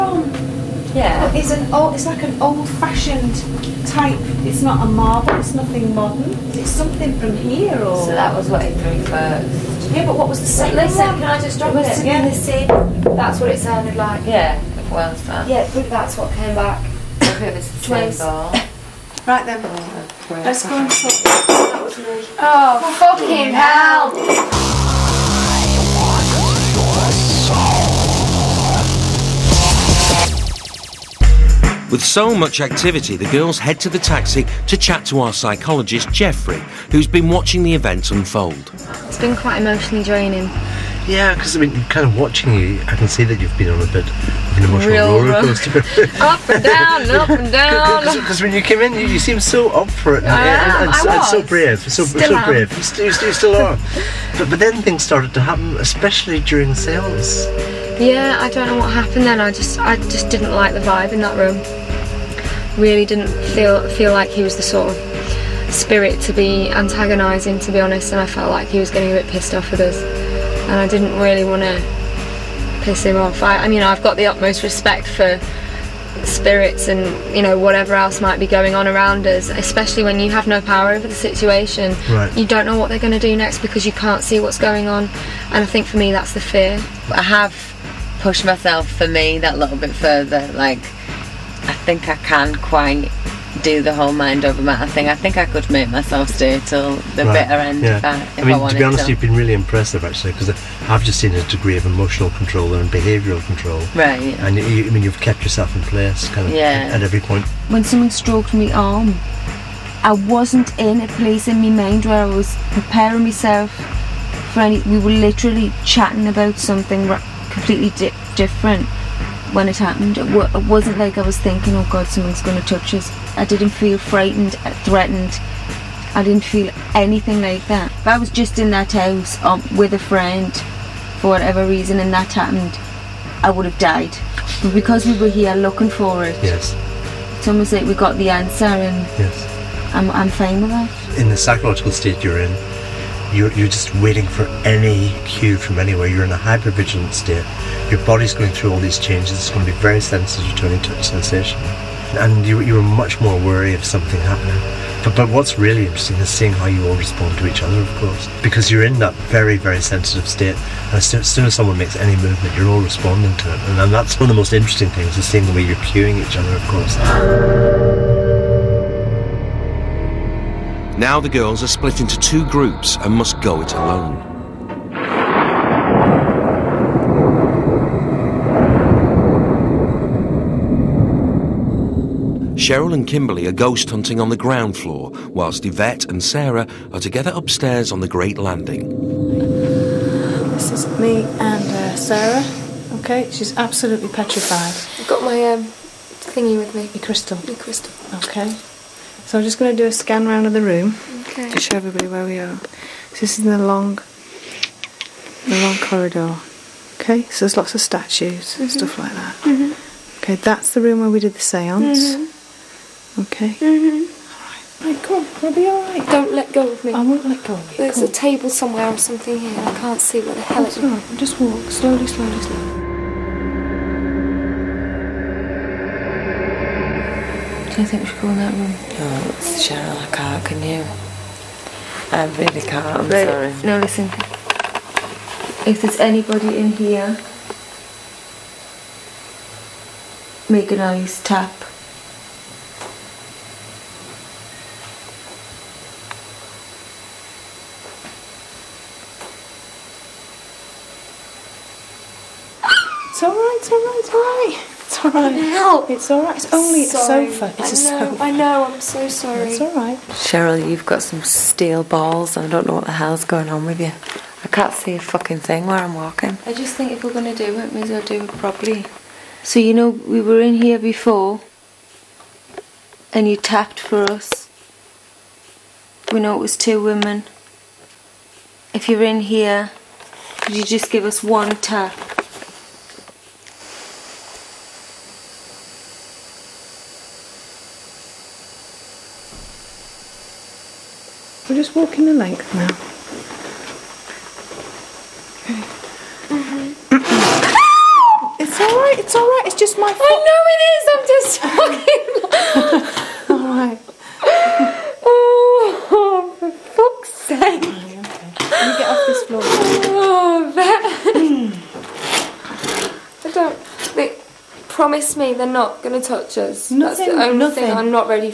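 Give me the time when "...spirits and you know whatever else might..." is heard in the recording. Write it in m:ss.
1:16.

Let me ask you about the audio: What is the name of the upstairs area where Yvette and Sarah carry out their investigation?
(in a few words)
the Great Landing.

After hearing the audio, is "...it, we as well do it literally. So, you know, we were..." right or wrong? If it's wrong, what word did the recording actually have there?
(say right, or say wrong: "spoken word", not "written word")
wrong: "properly", not "literally".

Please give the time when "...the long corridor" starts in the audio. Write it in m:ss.
3:25.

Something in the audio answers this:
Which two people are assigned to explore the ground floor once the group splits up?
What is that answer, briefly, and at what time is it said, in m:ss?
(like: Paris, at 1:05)
Cheryl and Kimberley, at 3:02.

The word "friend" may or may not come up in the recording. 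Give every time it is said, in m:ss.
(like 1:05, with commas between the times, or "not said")
2:09.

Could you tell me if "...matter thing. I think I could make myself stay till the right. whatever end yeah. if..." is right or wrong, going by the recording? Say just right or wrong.
wrong.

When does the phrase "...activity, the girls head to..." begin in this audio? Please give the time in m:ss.
0:32.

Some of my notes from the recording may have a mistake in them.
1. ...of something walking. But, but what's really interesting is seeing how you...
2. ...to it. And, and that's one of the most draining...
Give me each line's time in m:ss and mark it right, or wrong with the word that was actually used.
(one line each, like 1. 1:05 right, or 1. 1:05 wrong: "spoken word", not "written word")
1. 2:33 wrong: "happening", not "walking"
2. 2:43 wrong: "interesting", not "draining".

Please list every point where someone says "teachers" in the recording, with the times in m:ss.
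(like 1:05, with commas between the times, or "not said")
not said.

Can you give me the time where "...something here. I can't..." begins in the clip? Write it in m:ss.
3:38.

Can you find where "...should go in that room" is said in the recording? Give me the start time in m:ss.
3:48.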